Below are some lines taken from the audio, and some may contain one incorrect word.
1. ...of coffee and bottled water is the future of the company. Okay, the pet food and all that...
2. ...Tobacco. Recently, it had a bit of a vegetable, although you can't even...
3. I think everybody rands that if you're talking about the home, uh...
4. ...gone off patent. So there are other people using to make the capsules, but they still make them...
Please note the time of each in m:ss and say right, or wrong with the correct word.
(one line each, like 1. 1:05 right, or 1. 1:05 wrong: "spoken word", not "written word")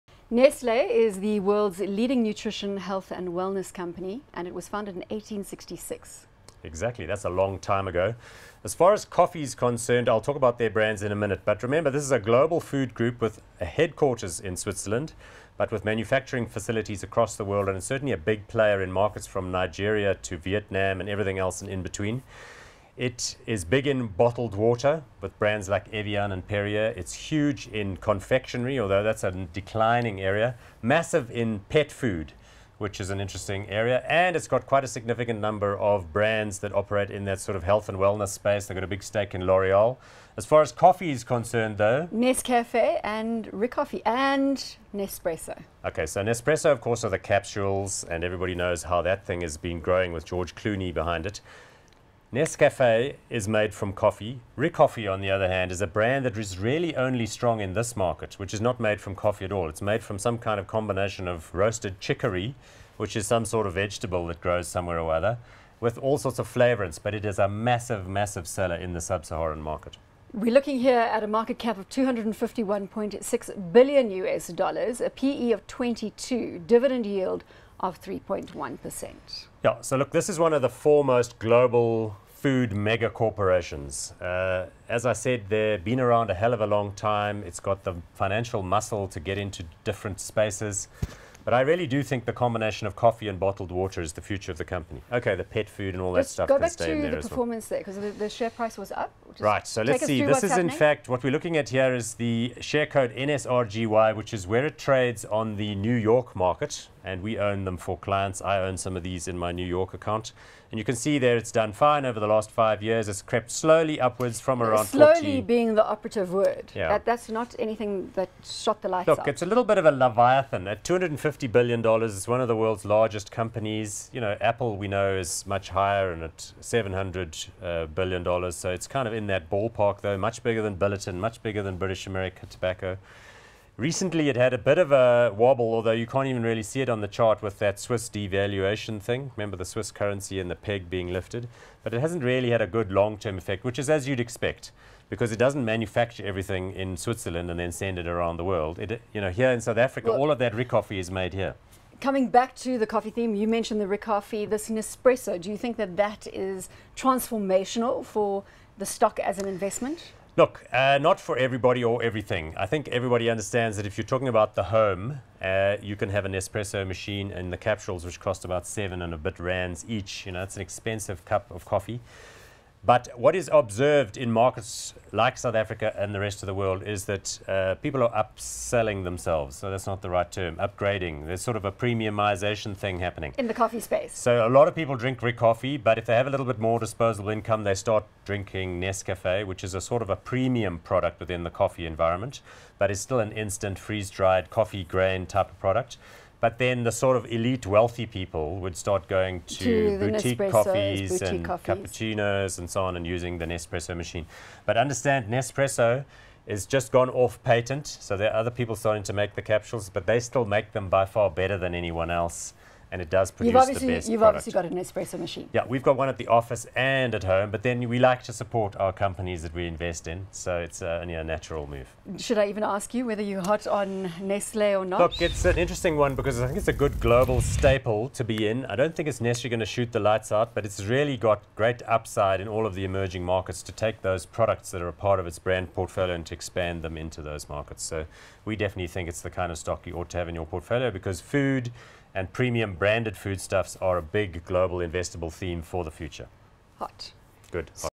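1. 1:32 right
2. 2:12 wrong: "wobble", not "vegetable"
3. 2:42 wrong: "understands", not "rands"
4. 3:26 wrong: "starting", not "using".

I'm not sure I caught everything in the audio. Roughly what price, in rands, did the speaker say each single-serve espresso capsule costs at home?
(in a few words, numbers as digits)
about 7 rands.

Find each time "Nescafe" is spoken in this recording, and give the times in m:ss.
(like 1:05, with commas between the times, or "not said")
0:42, 0:52, 3:08.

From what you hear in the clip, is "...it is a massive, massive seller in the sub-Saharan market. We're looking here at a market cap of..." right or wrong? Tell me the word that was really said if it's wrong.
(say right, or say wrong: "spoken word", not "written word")
right.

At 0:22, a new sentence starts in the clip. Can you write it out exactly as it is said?
It is big in bottled water with brands like Evian and Perrier.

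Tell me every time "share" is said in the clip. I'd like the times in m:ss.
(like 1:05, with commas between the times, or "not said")
1:38, 1:42.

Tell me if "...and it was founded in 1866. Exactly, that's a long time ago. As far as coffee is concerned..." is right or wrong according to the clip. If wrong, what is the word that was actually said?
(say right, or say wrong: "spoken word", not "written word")
right.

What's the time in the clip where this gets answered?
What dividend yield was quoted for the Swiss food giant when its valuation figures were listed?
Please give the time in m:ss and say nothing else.
1:18.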